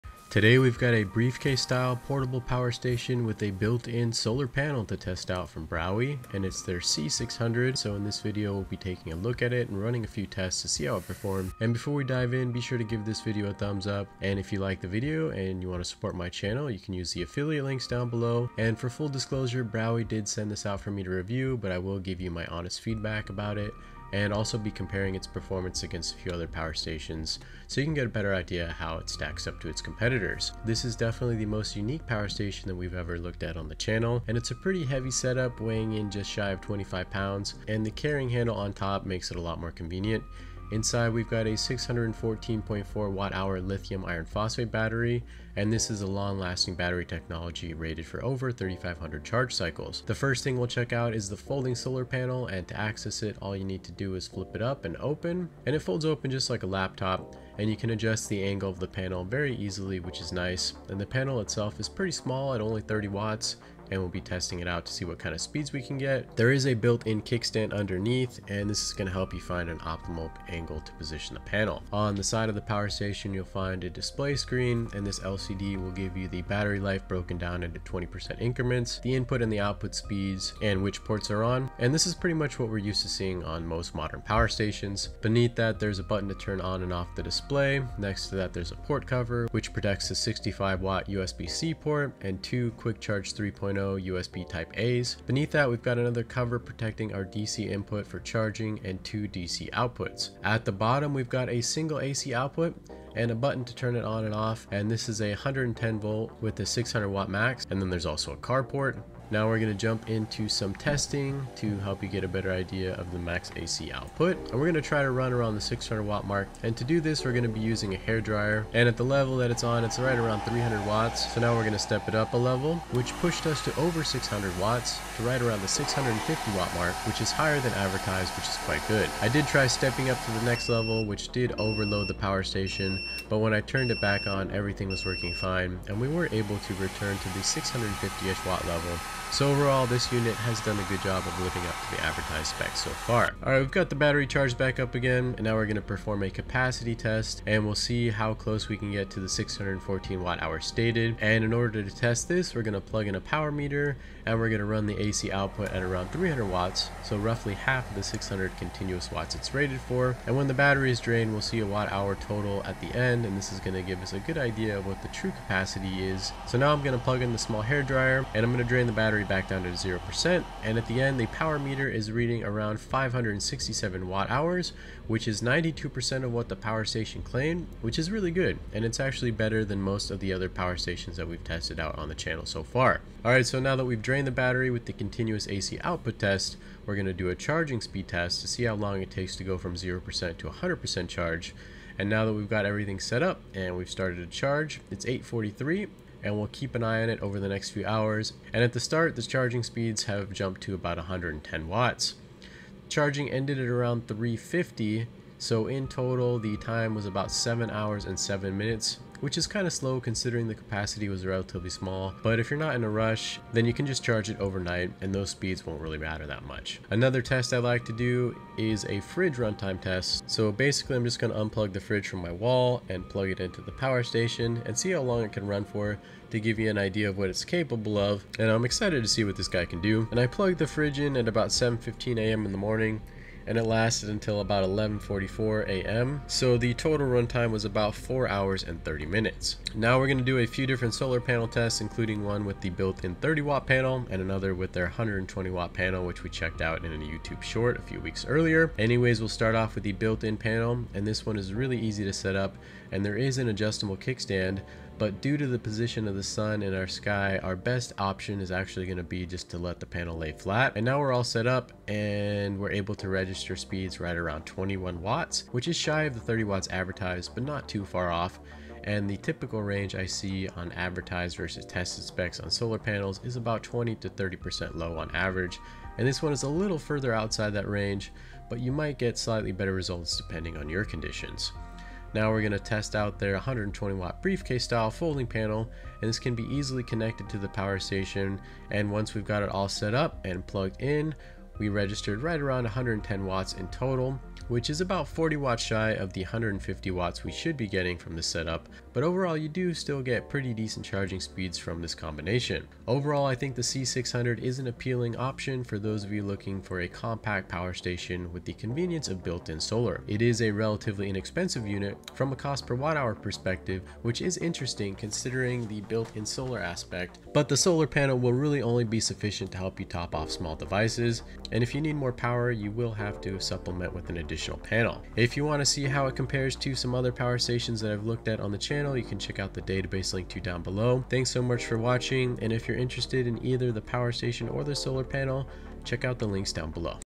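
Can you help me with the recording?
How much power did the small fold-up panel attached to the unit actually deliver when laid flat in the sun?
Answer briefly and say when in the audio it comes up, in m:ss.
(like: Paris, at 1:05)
21 watts, at 4:24.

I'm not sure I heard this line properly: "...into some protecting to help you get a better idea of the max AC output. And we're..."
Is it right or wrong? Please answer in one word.
wrong.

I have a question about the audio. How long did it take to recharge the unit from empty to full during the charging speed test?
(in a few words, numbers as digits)
7 hours 7 minutes.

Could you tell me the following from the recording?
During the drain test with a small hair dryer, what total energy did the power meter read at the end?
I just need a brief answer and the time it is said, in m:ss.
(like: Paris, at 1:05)
567 watt hours, at 2:52.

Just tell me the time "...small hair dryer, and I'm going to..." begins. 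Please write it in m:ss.
2:47.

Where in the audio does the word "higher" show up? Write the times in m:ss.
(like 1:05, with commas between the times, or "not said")
2:07.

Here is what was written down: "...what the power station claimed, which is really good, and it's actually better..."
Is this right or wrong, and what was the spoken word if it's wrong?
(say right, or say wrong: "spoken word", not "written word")
right.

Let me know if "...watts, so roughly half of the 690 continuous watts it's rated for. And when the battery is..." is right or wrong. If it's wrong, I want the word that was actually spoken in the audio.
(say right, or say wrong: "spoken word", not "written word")
wrong: "600", not "690".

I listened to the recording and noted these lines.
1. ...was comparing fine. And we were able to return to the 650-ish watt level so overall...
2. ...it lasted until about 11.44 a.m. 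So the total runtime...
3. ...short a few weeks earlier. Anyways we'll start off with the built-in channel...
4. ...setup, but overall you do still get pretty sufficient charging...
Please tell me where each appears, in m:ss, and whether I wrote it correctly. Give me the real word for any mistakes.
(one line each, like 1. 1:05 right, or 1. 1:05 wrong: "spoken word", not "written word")
1. 2:14 wrong: "working", not "comparing"
2. 3:53 right
3. 4:07 wrong: "panel", not "channel"
4. 4:58 wrong: "decent", not "sufficient".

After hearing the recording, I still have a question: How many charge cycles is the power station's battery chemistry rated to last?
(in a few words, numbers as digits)
over 3500.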